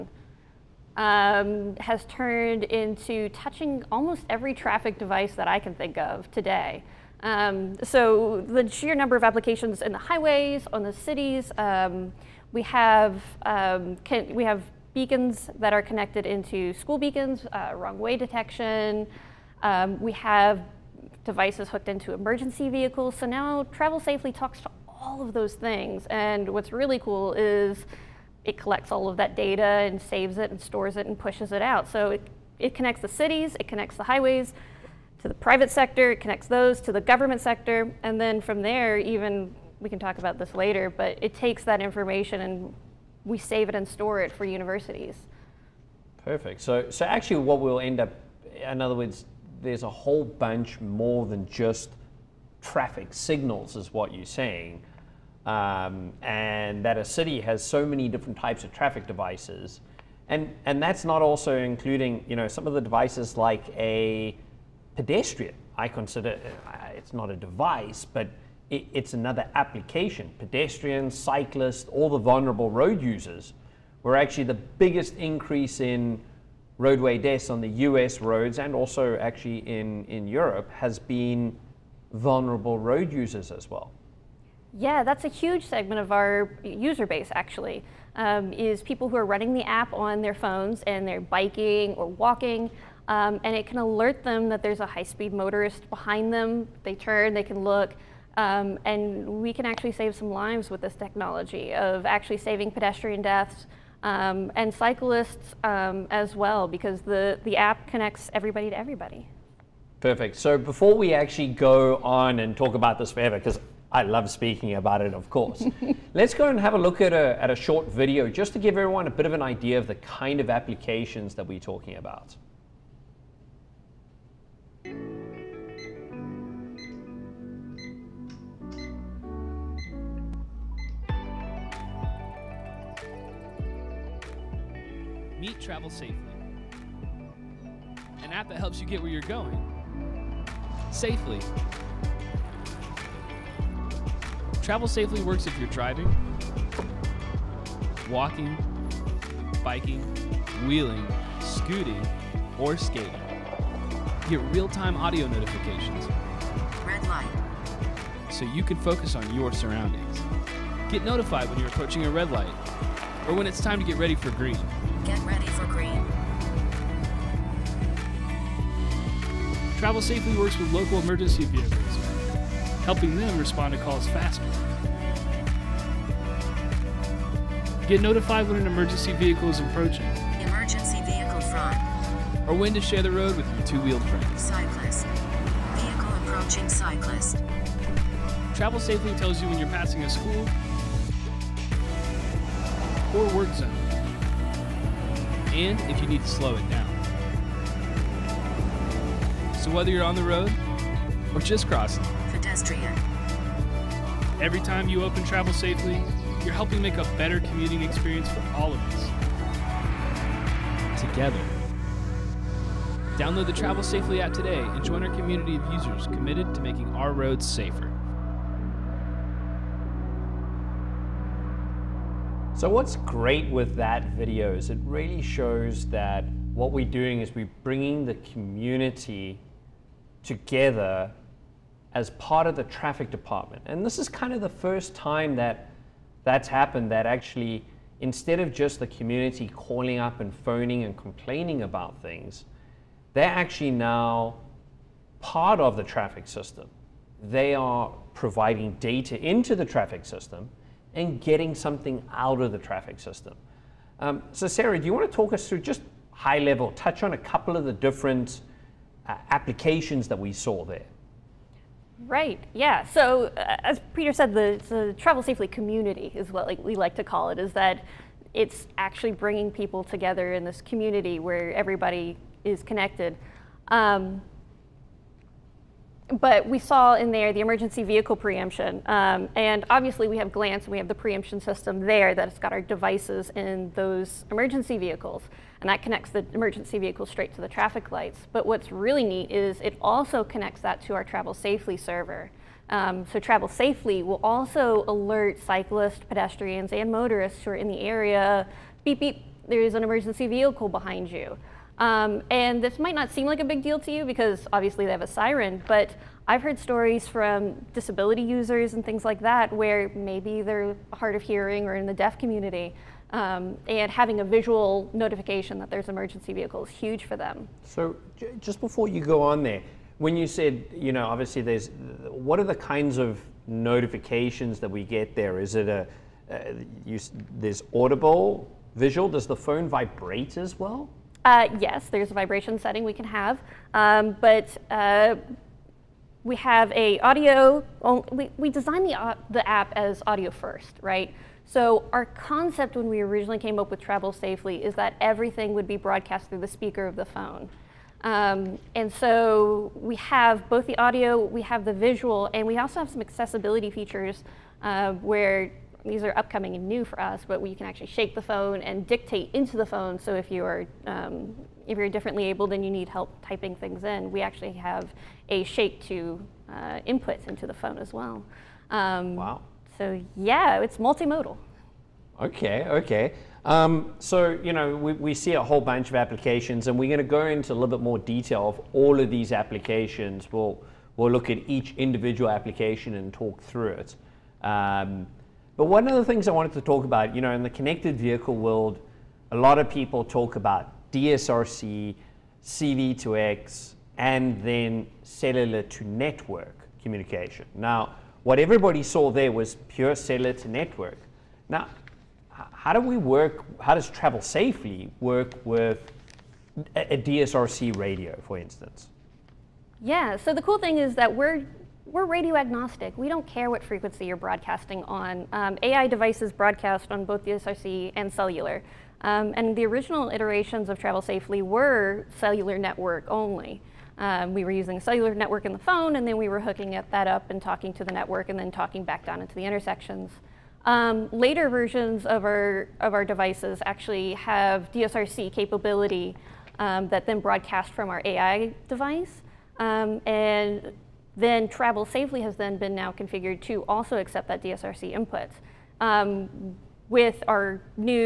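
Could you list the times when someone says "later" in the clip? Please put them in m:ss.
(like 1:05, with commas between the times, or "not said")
0:40, 7:11.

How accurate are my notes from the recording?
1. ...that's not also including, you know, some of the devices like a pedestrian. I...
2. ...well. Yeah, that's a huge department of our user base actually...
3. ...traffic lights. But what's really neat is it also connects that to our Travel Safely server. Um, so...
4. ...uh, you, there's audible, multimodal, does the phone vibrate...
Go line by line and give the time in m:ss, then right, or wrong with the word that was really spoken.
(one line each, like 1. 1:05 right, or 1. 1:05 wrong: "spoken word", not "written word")
1. 1:00 right
2. 1:23 wrong: "segment", not "department"
3. 4:47 right
4. 5:26 wrong: "visual", not "multimodal".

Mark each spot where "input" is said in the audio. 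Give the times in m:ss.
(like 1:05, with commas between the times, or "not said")
6:06, 7:24.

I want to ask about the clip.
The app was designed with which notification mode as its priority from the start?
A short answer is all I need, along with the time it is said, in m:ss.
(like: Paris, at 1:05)
Audio first, at 5:40.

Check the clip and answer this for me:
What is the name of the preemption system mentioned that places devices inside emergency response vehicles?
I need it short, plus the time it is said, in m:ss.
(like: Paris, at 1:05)
Glance, at 4:40.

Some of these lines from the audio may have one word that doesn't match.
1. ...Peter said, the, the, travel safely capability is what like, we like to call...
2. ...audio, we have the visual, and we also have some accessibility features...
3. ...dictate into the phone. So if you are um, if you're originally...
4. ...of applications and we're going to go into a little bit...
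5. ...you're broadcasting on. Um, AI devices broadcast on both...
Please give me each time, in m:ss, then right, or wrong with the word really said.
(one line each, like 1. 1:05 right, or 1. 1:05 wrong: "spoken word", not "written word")
1. 4:23 wrong: "community", not "capability"
2. 5:50 right
3. 5:58 wrong: "differently", not "originally"
4. 6:15 right
5. 6:54 right.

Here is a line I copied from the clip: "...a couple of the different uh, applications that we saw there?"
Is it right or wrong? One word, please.
right.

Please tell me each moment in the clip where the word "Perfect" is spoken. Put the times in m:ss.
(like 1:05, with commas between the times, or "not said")
0:46, 1:49.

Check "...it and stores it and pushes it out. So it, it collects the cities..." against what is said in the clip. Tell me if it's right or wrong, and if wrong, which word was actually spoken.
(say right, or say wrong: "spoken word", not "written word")
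wrong: "connects", not "collects".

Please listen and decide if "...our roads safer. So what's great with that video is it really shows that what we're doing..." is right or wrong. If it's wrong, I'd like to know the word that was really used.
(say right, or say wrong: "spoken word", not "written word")
right.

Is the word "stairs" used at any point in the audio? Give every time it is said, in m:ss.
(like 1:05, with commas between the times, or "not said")
not said.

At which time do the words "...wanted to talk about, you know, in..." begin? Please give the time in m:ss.
6:26.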